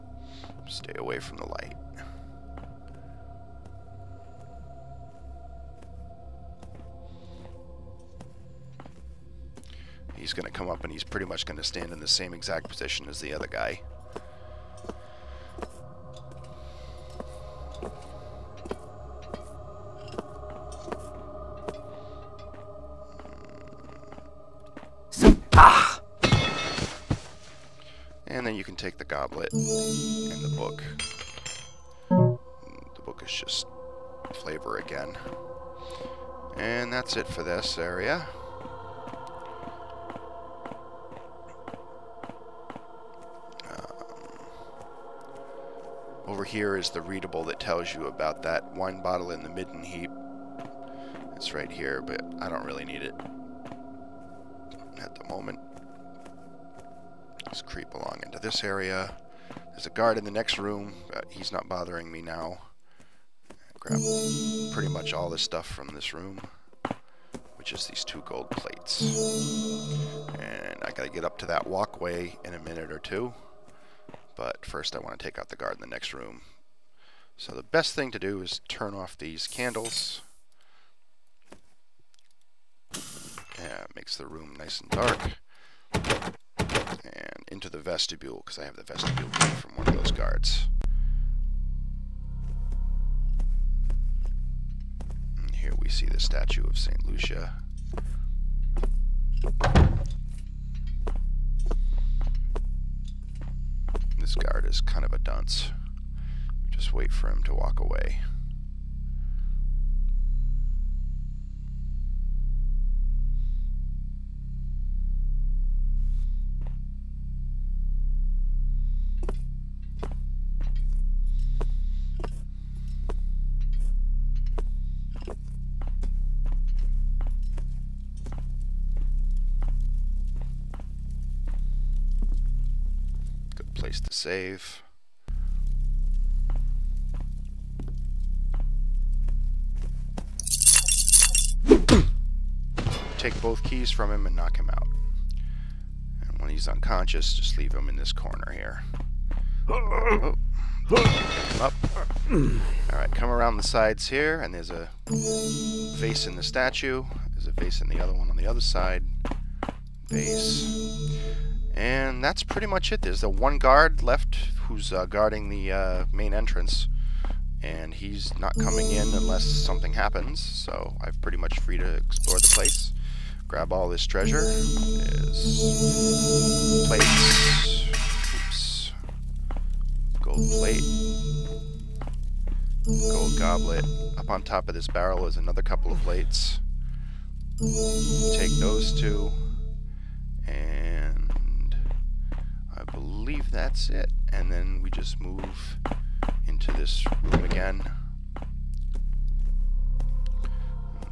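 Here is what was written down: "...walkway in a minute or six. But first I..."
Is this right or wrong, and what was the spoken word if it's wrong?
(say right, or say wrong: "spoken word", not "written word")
wrong: "two", not "six".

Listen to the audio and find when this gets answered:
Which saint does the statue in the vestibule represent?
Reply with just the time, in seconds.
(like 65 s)
96 s.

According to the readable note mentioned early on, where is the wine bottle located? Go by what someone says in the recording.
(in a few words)
midden heap.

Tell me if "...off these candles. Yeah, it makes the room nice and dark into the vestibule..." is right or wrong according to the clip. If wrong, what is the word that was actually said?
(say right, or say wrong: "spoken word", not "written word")
right.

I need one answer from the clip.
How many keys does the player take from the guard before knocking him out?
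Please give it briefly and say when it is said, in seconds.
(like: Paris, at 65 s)
2, at 143 s.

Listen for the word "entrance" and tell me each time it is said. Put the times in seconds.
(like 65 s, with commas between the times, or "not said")
166 s.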